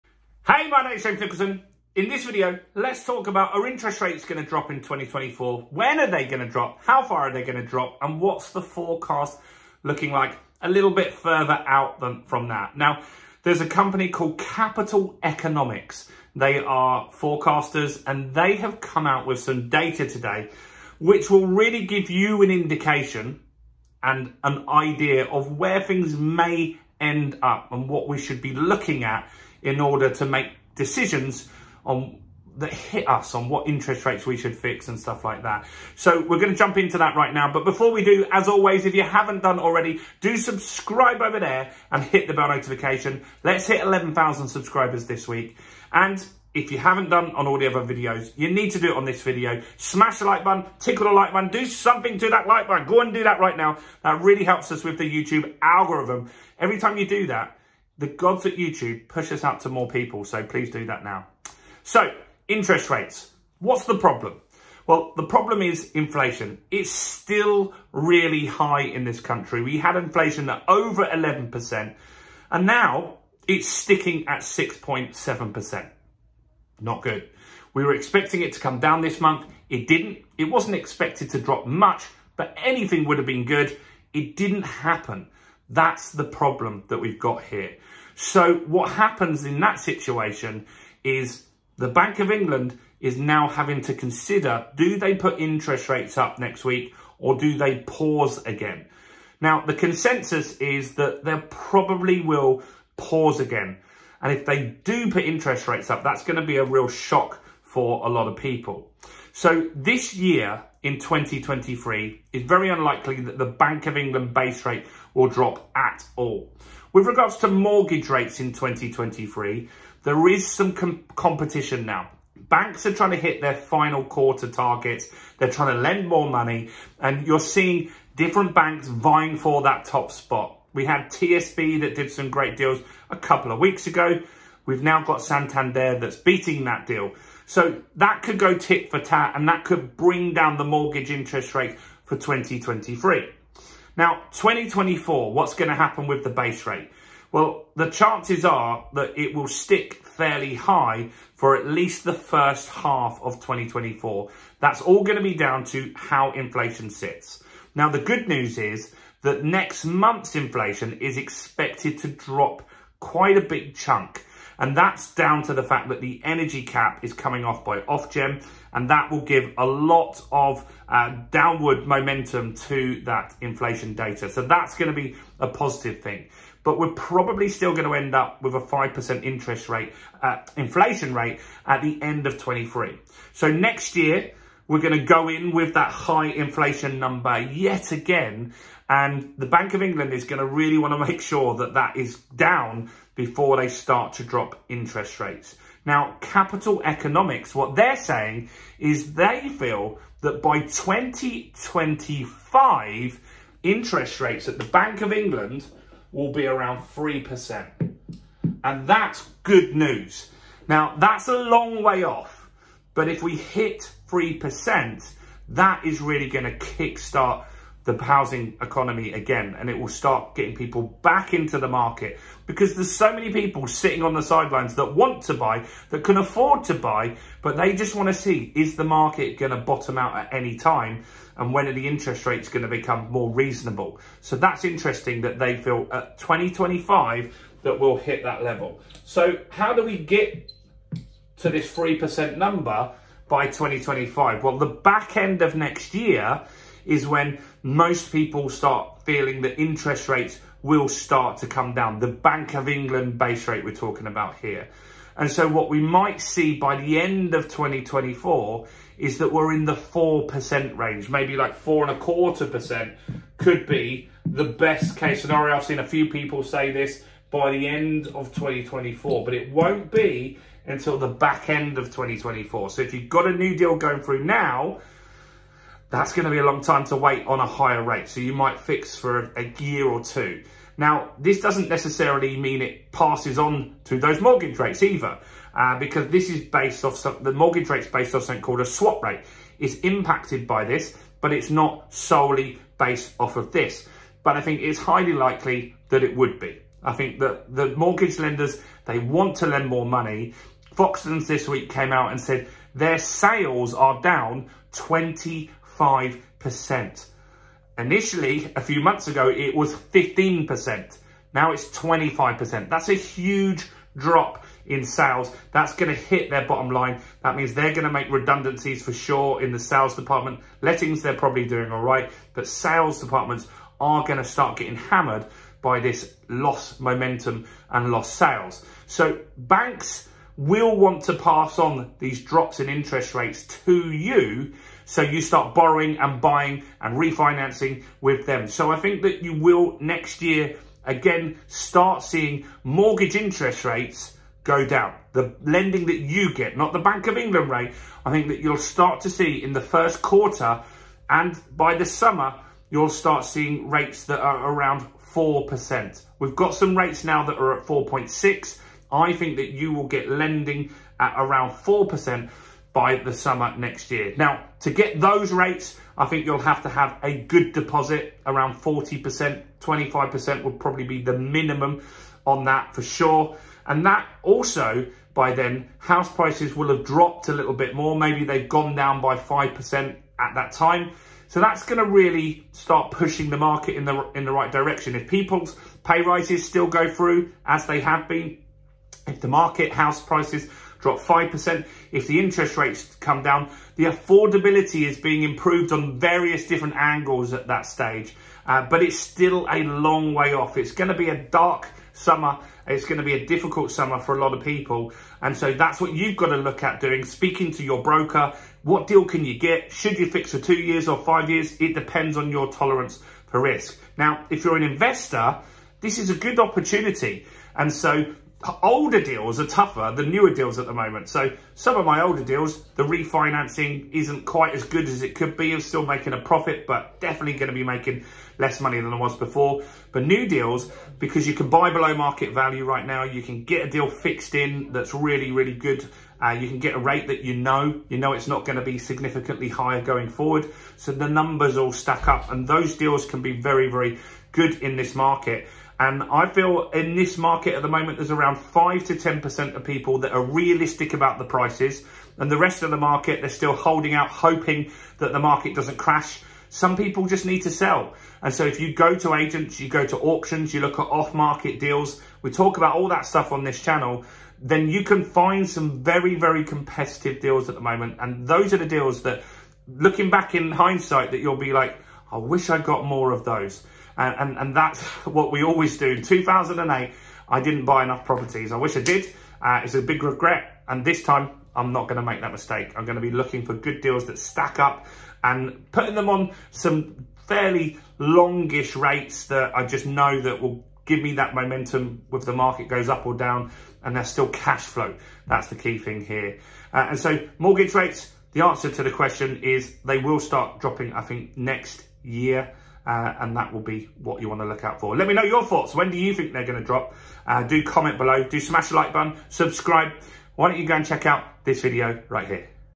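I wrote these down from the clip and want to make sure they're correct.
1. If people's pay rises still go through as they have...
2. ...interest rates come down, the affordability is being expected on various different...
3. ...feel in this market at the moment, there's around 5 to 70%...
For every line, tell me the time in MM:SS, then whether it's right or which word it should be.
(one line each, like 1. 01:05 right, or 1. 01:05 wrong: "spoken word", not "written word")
1. 06:24 right
2. 06:32 wrong: "improved", not "expected"
3. 07:26 wrong: "10", not "70".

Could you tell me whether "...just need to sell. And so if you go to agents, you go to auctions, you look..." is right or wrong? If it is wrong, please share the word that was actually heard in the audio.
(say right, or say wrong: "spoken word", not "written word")
right.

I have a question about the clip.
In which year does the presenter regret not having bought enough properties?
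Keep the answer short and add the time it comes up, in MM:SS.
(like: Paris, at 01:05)
2008, at 07:56.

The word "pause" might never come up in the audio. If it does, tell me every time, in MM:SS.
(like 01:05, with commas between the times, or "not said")
01:37, 01:42.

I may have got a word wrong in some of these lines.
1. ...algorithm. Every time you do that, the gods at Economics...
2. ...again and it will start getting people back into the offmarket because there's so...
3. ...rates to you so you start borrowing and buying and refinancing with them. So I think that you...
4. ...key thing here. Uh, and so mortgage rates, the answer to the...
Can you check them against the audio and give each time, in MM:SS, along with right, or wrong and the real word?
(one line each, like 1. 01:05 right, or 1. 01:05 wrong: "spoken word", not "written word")
1. 00:55 wrong: "YouTube", not "Economics"
2. 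03:39 wrong: "market", not "offmarket"
3. 05:33 right
4. 08:15 right.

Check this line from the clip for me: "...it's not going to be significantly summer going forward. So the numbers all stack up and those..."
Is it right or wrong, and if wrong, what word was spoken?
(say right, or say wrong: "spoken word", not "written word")
wrong: "higher", not "summer".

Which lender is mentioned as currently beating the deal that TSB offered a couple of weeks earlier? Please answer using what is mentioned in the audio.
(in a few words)
Santander.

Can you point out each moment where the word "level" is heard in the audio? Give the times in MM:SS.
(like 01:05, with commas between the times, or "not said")
03:58.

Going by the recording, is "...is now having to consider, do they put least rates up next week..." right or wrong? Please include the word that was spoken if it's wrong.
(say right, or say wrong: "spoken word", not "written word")
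wrong: "interest", not "least".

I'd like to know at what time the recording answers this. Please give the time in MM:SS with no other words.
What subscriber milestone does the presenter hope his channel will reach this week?
00:43.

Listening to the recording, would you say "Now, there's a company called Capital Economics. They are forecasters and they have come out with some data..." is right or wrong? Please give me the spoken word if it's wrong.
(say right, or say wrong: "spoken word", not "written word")
right.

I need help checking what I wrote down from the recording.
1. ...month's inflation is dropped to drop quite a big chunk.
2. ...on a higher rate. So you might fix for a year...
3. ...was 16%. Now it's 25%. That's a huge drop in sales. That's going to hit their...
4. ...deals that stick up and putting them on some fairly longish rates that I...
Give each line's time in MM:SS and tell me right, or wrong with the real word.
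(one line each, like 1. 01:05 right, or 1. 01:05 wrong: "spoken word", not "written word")
1. 02:39 wrong: "expected", not "dropped"
2. 04:37 right
3. 05:09 wrong: "15", not "16"
4. 08:03 wrong: "stack", not "stick".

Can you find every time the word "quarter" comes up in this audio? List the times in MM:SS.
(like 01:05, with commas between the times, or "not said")
02:04, 04:21, 05:50.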